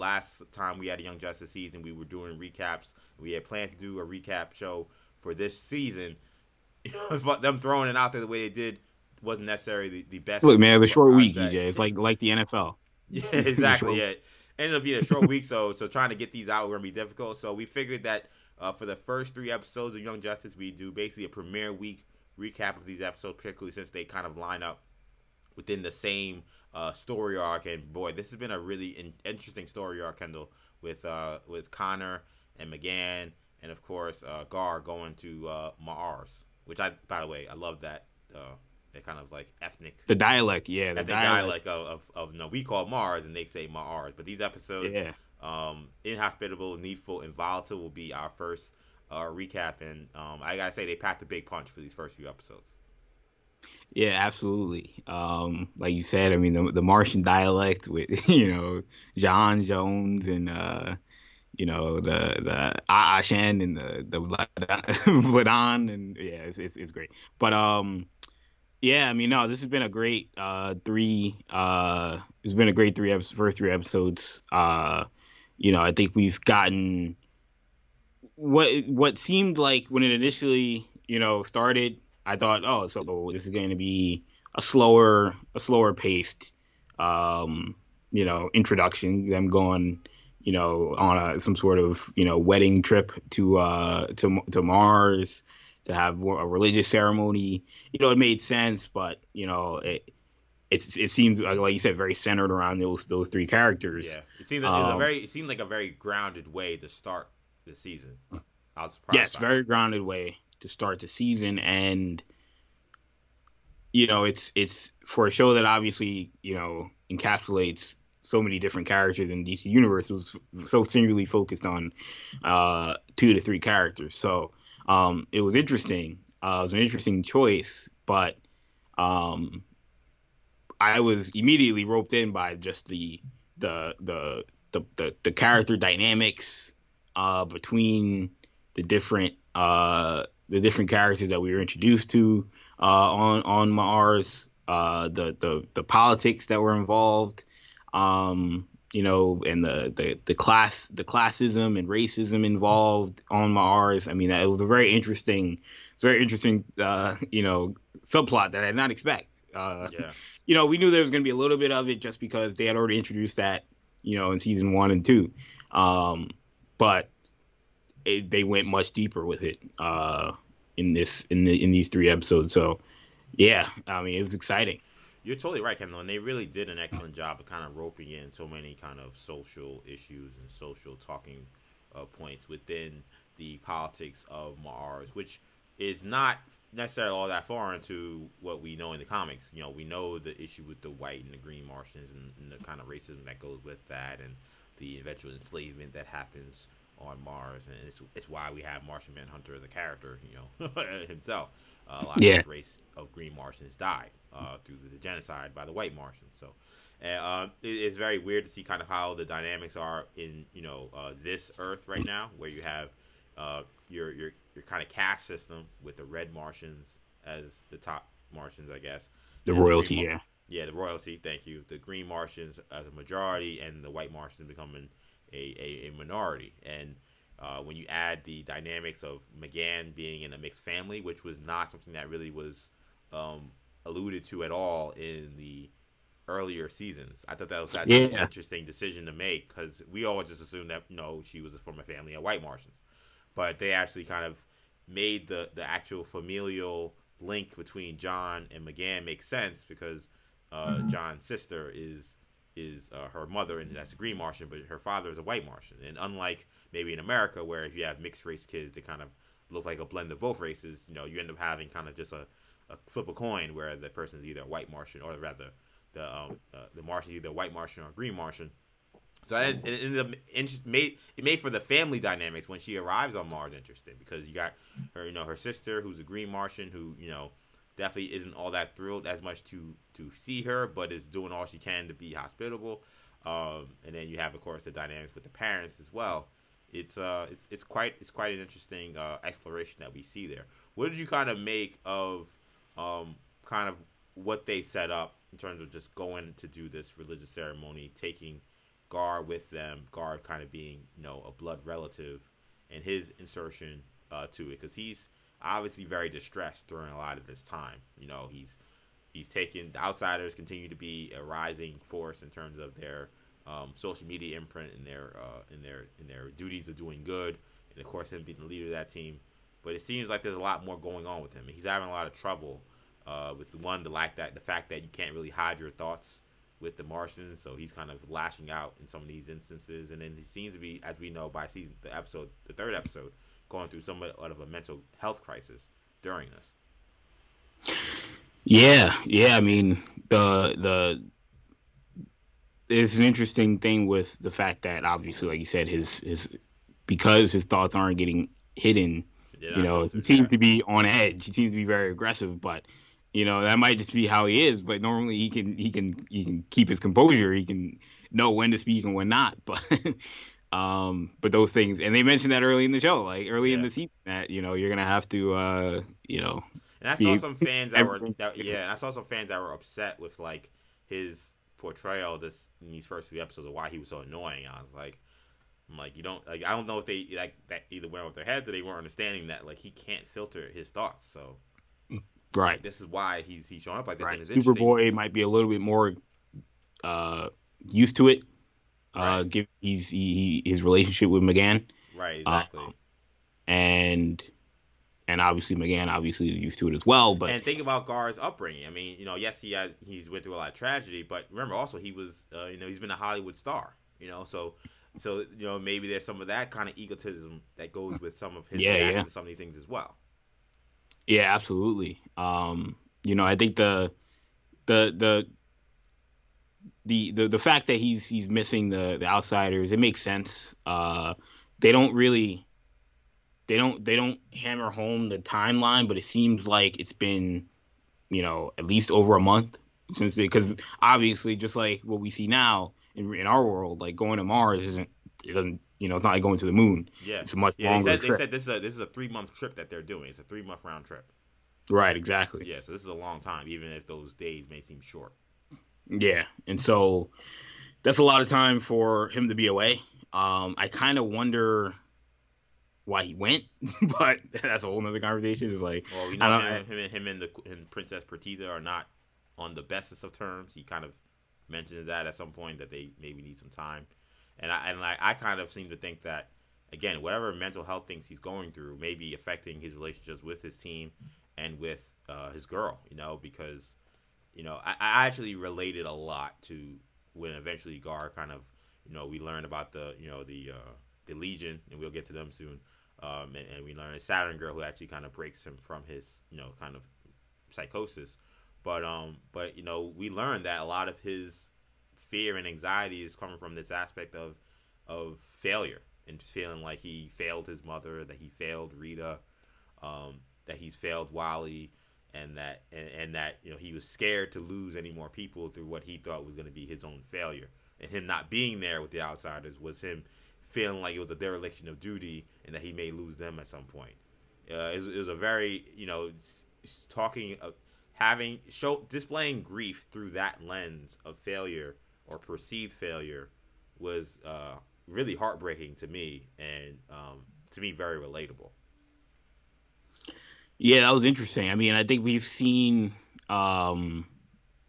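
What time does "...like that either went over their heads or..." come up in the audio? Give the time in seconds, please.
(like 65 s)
377 s.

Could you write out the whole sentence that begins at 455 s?
It's like, well, we know I, him, and him and the and Princess Perdita are not on the bestest of terms.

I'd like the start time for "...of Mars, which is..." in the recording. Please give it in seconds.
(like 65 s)
184 s.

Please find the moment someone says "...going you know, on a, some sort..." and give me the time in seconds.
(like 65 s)
89 s.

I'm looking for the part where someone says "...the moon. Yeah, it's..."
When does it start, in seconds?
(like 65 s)
436 s.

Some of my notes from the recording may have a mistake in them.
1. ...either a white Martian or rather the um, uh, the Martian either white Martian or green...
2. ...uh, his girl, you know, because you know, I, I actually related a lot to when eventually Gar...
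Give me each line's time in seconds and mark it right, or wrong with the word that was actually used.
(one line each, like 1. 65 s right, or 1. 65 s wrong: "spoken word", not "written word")
1. 264 s right
2. 472 s right.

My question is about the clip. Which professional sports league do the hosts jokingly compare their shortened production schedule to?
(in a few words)
NFL.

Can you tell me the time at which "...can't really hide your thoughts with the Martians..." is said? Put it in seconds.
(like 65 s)
324 s.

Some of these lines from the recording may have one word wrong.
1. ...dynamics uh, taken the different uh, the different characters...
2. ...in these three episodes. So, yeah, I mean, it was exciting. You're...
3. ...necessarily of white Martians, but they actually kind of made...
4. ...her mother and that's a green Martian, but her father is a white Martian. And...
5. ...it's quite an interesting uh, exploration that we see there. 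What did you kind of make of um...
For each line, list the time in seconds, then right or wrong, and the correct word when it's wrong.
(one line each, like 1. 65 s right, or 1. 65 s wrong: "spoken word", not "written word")
1. 135 s wrong: "between", not "taken"
2. 171 s right
3. 241 s wrong: "family", not "necessarily"
4. 253 s right
5. 288 s right.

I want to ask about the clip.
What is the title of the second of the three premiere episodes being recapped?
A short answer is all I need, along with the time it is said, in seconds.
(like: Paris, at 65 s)
Needful, at 46 s.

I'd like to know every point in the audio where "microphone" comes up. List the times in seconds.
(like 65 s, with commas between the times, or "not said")
not said.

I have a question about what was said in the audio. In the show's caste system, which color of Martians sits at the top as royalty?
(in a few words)
Red.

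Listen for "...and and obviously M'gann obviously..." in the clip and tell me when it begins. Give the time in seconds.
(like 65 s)
393 s.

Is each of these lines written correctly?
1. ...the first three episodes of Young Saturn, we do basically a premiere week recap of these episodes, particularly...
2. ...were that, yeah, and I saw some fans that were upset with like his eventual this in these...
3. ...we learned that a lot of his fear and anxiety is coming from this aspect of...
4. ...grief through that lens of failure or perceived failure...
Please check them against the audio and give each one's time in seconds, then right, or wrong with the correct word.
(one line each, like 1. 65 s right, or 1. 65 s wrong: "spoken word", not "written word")
1. 18 s wrong: "Justice", not "Saturn"
2. 367 s wrong: "portrayal", not "eventual"
3. 489 s right
4. 519 s right.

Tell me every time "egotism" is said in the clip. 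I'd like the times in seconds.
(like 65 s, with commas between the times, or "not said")
406 s.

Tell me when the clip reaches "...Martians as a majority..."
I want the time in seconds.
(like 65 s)
222 s.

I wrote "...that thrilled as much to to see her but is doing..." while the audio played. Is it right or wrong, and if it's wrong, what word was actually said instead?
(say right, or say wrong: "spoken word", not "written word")
right.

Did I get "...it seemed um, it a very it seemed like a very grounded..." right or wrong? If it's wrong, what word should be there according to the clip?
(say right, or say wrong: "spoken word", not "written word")
right.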